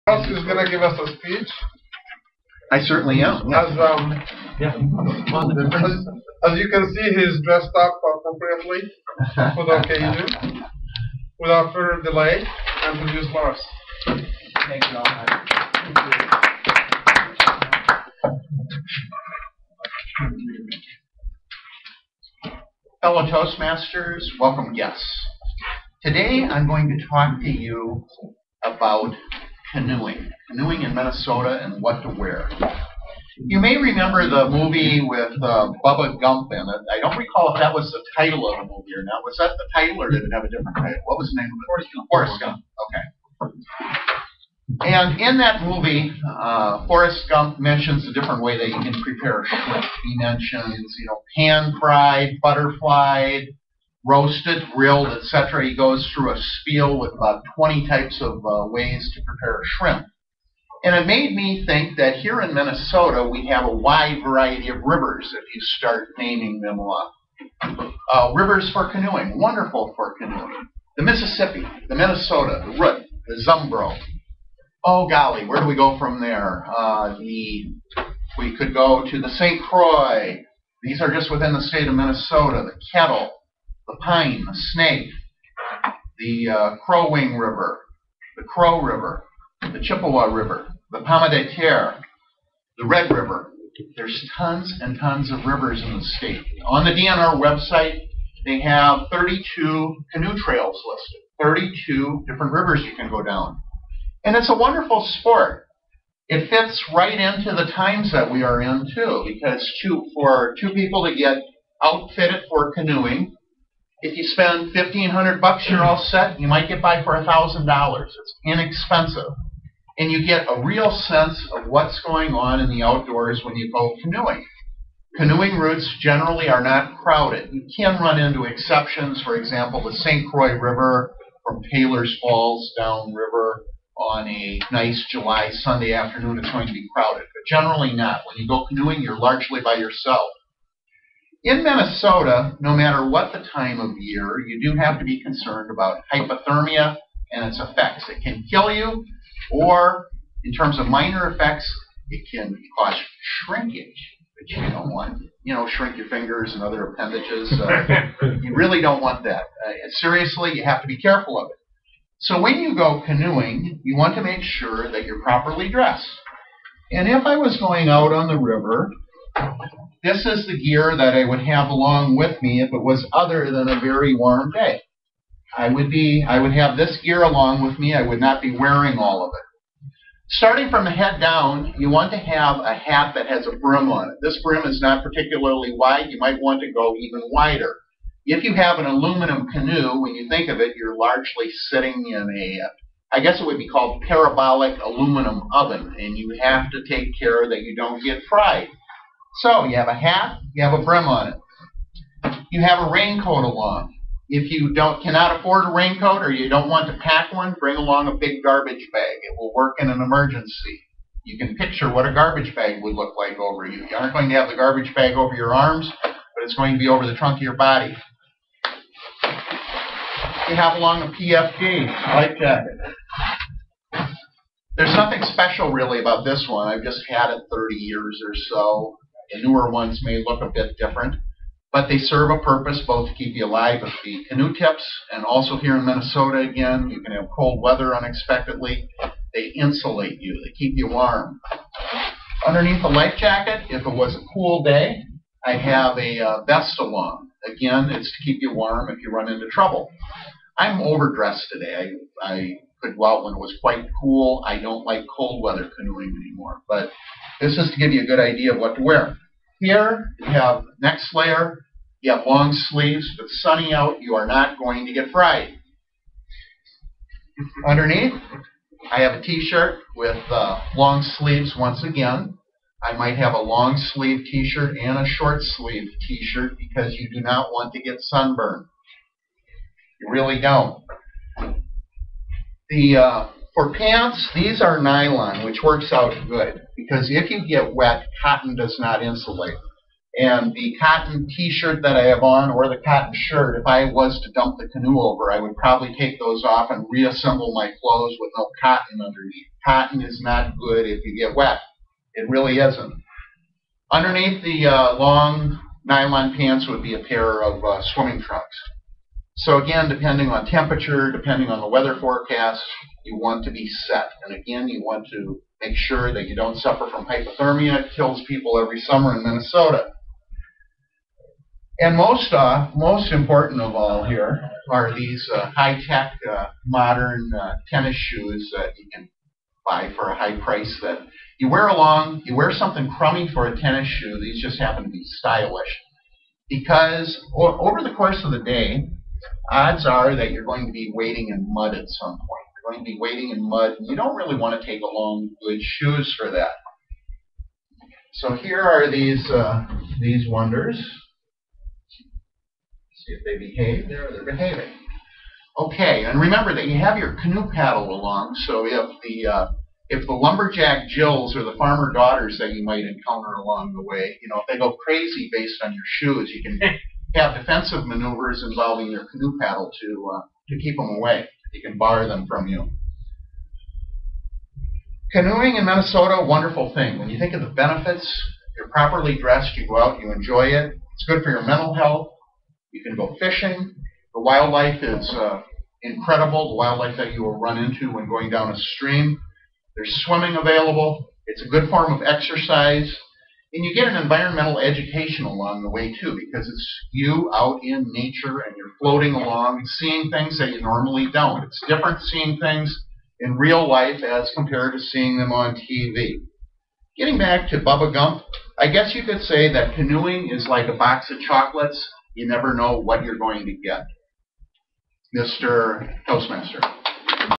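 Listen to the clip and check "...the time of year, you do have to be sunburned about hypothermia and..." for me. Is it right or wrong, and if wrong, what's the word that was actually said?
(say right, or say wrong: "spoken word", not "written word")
wrong: "concerned", not "sunburned".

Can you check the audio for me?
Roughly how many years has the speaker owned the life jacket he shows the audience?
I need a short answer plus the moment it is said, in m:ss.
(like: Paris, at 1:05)
30, at 3:47.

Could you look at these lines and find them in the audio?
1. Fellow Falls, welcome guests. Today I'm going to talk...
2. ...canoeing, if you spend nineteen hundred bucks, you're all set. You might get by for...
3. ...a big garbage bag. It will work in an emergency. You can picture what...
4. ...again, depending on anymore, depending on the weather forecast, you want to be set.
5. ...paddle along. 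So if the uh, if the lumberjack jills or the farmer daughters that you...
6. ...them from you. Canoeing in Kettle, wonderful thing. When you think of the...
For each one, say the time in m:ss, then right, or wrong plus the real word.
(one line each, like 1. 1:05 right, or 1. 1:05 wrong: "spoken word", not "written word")
1. 0:23 wrong: "Toastmasters", not "Falls"
2. 1:52 wrong: "fifteen", not "nineteen"
3. 3:28 right
4. 5:09 wrong: "temperature", not "anymore"
5. 5:57 right
6. 6:12 wrong: "Minnesota", not "Kettle".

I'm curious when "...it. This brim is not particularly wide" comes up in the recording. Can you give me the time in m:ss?
3:04.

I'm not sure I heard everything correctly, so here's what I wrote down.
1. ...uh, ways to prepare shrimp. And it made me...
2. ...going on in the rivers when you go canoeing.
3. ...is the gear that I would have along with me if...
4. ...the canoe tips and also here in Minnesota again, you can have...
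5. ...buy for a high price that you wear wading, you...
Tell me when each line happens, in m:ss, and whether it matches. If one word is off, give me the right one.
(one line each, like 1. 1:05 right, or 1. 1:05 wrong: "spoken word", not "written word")
1. 0:58 right
2. 2:02 wrong: "outdoors", not "rivers"
3. 2:50 right
4. 3:54 right
5. 5:29 wrong: "along", not "wading".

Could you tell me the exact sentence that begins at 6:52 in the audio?
You never know what you're going to get.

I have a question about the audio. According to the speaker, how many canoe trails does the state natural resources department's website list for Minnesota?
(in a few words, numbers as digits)
32.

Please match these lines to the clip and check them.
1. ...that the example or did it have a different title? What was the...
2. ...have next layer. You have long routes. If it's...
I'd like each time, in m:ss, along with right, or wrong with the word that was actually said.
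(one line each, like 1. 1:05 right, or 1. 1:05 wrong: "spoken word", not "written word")
1. 0:39 wrong: "title", not "example"
2. 4:20 wrong: "sleeves", not "routes".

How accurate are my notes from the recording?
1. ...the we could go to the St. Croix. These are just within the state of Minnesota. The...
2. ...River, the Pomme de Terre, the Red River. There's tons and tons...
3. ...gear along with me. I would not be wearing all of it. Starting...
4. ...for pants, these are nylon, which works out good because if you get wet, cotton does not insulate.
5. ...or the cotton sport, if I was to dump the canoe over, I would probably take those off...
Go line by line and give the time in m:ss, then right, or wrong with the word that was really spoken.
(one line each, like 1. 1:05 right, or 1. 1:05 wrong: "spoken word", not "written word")
1. 1:17 right
2. 1:30 right
3. 2:57 right
4. 4:43 right
5. 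4:52 wrong: "shirt", not "sport".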